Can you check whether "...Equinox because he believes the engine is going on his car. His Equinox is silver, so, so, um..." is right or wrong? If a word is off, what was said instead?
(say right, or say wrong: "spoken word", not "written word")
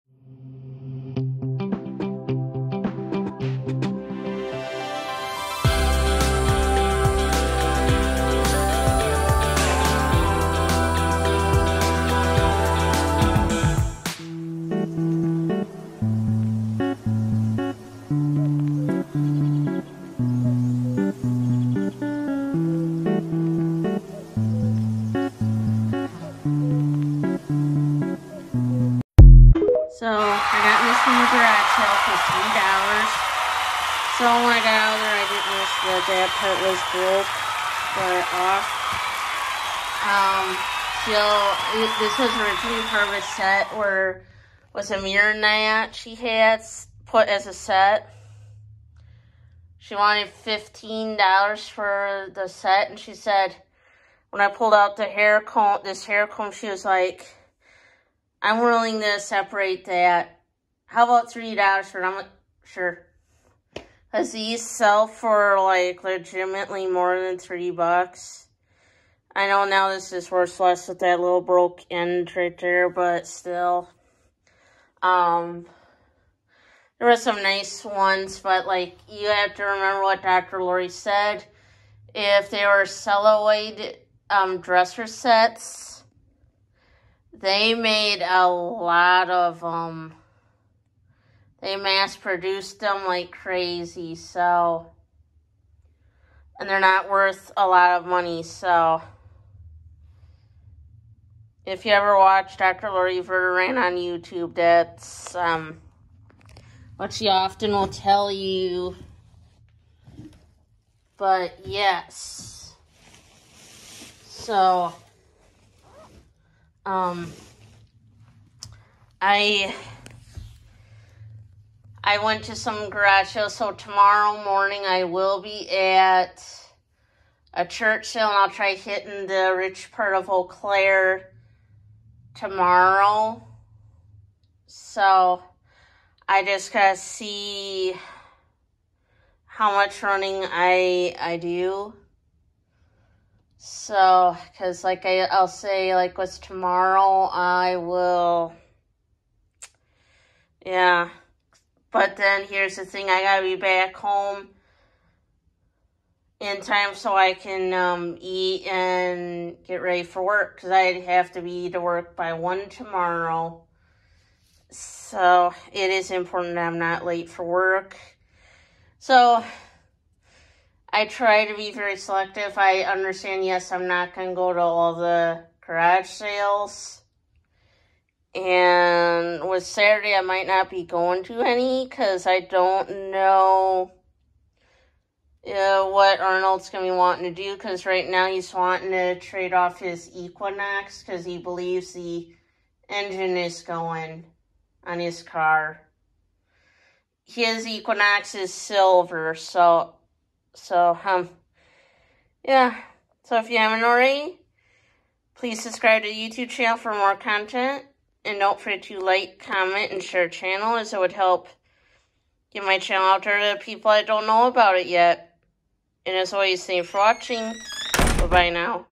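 right.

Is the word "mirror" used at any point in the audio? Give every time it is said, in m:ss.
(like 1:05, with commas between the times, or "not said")
0:45.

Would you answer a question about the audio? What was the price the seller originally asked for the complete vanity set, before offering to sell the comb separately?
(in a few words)
$15.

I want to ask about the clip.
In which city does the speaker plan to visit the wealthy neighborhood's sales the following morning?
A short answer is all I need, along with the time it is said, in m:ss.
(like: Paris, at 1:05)
Eau Claire, at 2:10.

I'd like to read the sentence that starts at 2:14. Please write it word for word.
So, I just gotta see how much running I I do.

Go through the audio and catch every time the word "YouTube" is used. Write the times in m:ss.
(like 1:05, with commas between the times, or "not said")
1:43, 3:26.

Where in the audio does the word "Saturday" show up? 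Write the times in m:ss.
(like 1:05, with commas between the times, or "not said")
2:59.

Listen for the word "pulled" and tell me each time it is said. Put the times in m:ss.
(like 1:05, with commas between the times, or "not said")
0:54.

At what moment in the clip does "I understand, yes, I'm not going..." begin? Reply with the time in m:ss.
2:52.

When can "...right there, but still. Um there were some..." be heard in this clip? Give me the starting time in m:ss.
1:12.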